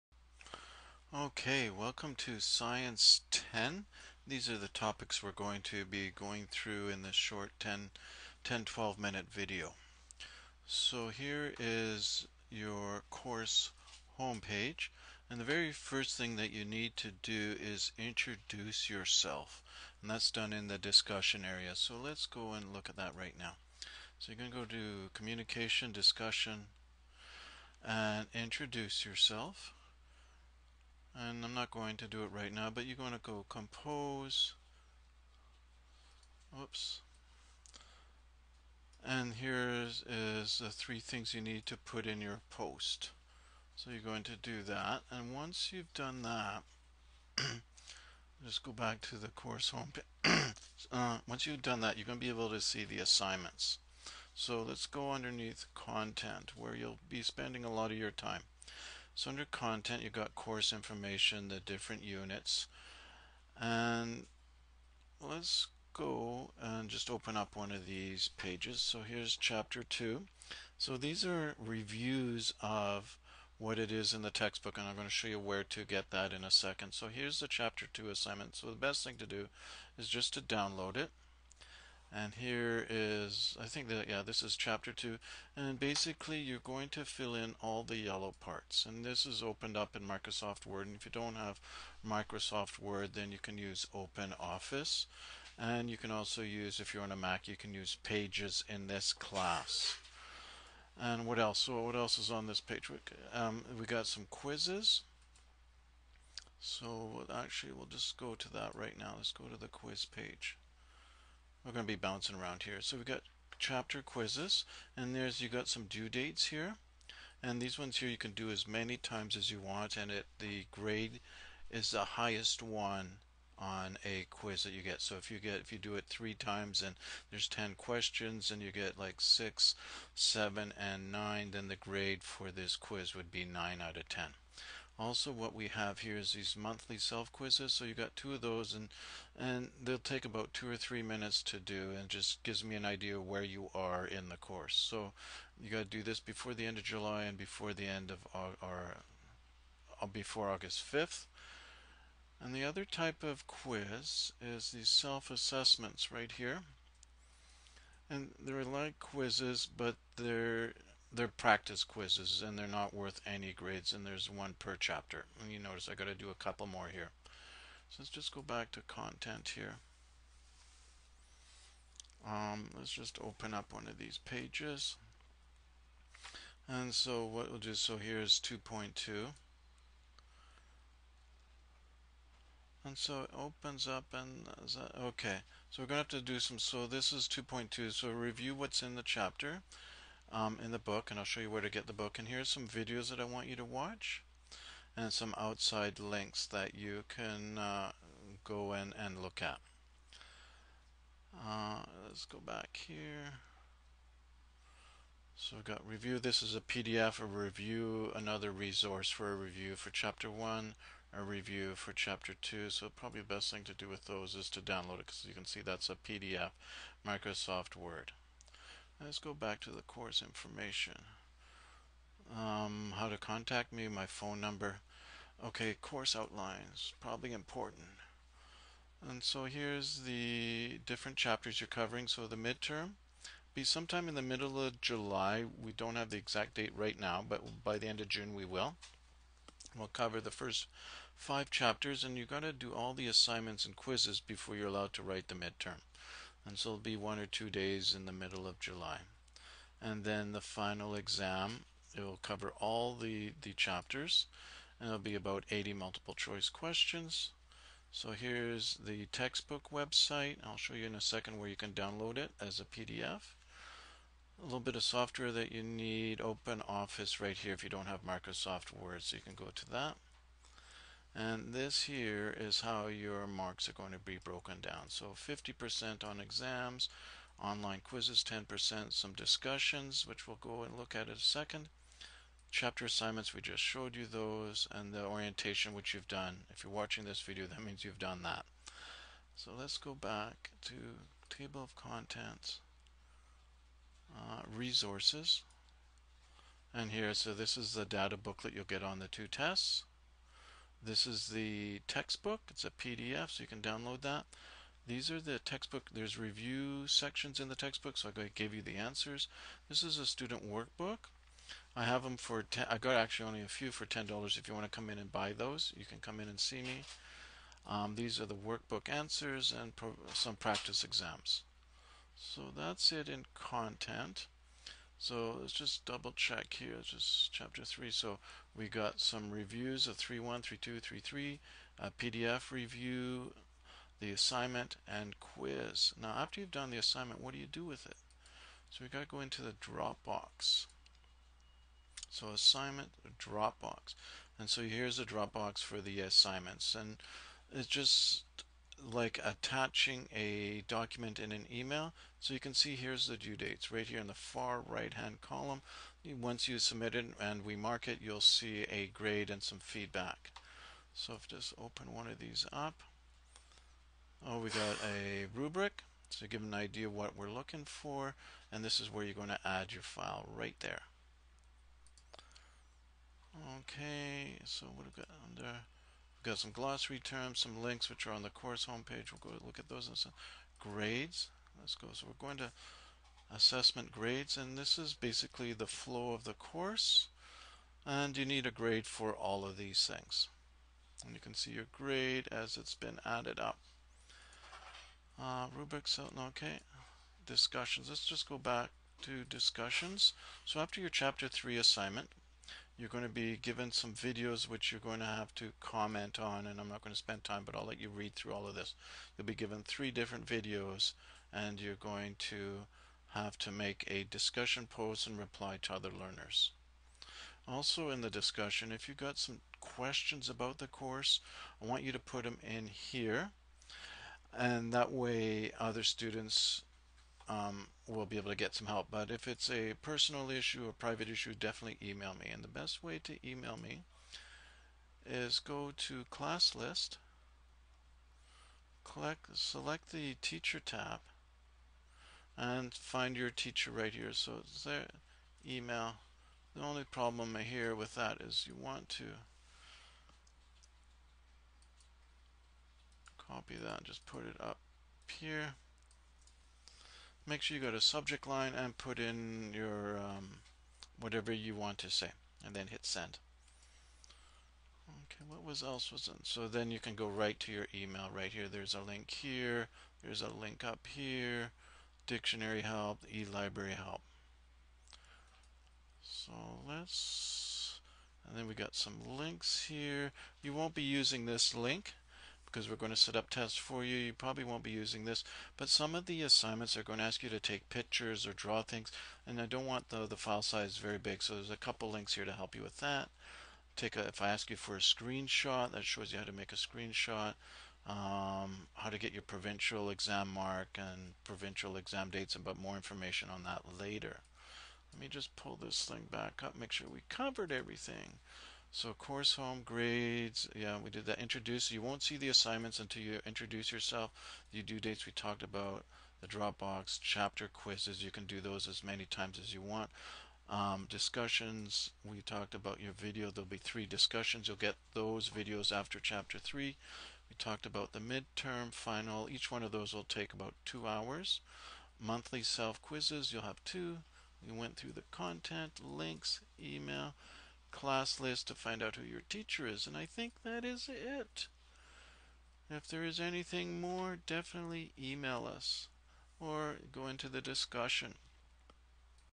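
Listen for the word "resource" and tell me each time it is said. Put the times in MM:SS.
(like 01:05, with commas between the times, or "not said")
03:28, 04:54.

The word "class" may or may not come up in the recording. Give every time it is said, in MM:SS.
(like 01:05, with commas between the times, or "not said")
01:39, 07:16, 08:57.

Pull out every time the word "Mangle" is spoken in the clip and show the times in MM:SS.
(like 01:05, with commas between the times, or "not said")
not said.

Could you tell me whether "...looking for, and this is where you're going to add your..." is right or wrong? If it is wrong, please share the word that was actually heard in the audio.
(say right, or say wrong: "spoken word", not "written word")
right.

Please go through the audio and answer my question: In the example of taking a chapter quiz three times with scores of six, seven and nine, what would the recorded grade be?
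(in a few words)
9 out of 10.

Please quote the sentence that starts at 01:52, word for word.
So we've got chapter quizzes, and there's you got some due dates here.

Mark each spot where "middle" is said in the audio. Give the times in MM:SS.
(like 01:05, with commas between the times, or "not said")
03:54, 04:08.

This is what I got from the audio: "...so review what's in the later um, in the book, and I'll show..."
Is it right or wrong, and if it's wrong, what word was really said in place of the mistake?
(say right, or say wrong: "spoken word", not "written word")
wrong: "chapter", not "later".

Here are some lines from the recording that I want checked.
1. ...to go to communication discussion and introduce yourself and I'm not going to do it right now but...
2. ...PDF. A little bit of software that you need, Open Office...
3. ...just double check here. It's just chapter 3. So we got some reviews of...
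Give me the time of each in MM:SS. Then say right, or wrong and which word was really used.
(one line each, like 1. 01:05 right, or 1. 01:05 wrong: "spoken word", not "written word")
1. 00:24 right
2. 04:22 right
3. 05:25 right.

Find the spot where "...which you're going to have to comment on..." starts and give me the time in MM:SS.
06:44.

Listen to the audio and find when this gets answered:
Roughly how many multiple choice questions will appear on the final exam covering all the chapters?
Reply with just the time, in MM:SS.
04:15.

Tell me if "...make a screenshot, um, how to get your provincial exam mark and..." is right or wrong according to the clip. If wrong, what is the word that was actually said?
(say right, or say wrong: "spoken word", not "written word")
right.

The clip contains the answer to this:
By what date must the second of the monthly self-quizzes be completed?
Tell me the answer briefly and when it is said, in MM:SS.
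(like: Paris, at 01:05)
August 5th, at 02:30.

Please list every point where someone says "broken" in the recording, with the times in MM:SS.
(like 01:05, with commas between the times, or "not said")
04:34.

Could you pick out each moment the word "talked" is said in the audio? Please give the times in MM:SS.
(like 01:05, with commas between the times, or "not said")
08:35, 08:42, 08:47.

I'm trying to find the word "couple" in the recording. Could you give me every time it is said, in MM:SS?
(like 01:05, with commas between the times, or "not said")
02:46, 08:11.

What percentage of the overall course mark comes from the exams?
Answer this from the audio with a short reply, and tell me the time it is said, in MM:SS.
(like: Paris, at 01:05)
50%, at 04:35.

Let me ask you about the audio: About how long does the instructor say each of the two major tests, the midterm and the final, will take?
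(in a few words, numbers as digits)
About two hours.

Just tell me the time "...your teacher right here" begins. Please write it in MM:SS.
07:23.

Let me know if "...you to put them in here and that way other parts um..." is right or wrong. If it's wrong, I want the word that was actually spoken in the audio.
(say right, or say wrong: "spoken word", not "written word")
wrong: "students", not "parts".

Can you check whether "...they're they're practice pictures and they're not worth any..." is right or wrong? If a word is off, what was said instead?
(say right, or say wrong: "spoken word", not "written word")
wrong: "quizzes", not "pictures".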